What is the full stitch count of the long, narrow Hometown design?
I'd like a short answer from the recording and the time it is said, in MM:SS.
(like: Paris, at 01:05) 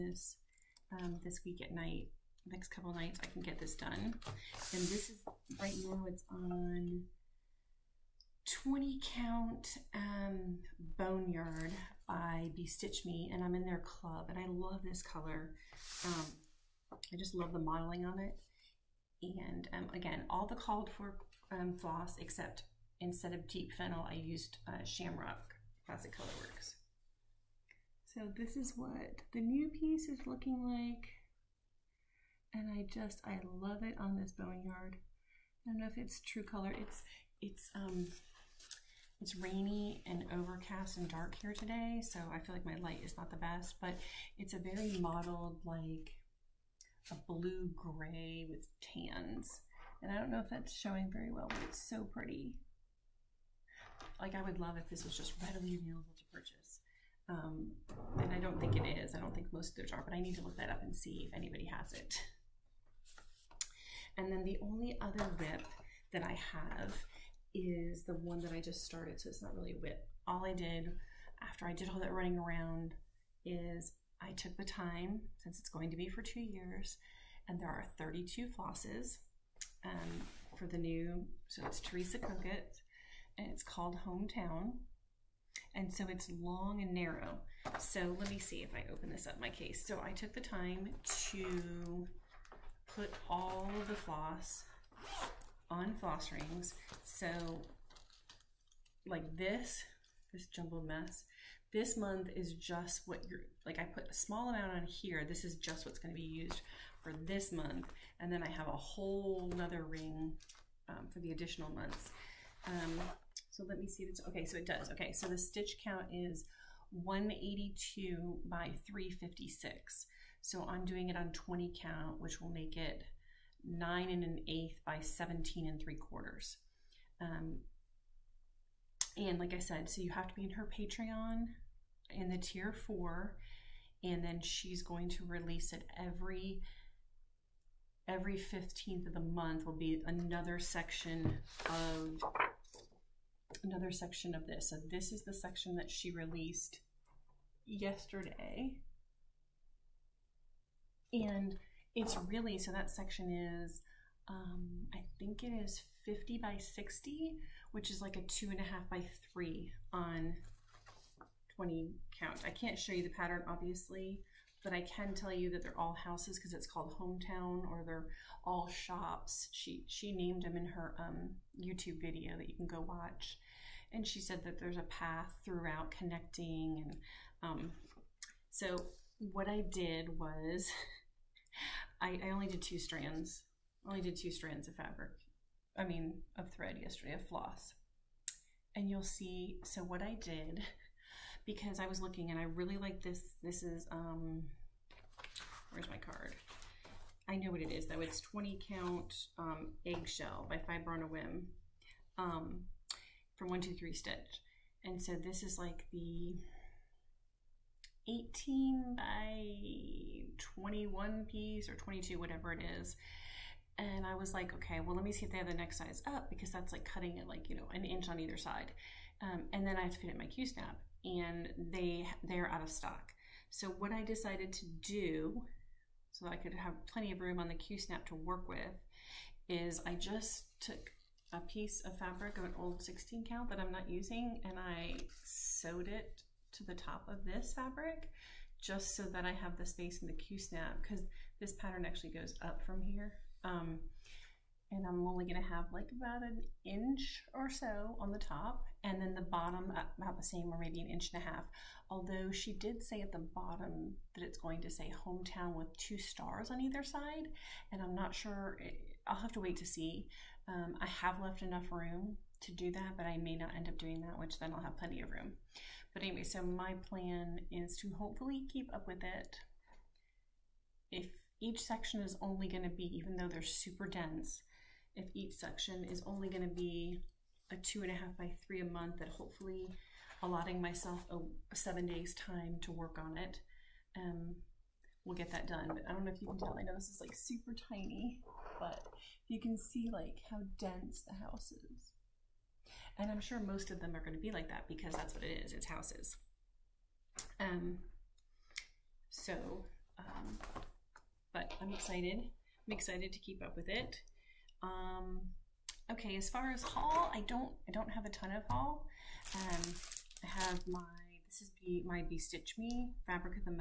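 182 by 356, at 01:56.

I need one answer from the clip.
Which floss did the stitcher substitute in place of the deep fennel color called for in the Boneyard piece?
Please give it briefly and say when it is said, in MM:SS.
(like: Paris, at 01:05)
Shamrock Classic Colorworks, at 00:24.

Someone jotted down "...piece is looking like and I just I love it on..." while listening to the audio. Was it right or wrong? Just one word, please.
right.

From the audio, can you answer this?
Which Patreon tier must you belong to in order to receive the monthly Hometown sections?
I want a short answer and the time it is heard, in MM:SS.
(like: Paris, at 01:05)
Tier 4, at 02:12.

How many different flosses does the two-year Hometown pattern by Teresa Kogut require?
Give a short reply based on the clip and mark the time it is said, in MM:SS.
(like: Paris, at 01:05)
32, at 01:17.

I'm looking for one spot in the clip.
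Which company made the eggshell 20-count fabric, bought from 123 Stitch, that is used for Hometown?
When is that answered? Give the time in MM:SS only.
03:20.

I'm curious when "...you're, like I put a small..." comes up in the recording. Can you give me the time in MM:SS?
01:43.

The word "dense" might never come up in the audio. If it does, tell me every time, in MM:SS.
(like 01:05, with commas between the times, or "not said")
04:33, 04:50.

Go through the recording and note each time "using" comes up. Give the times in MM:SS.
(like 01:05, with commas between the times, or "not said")
03:53.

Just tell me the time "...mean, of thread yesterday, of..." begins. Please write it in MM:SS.
03:05.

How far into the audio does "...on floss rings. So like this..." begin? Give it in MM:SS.
01:35.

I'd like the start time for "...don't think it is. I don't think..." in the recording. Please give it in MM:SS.
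00:58.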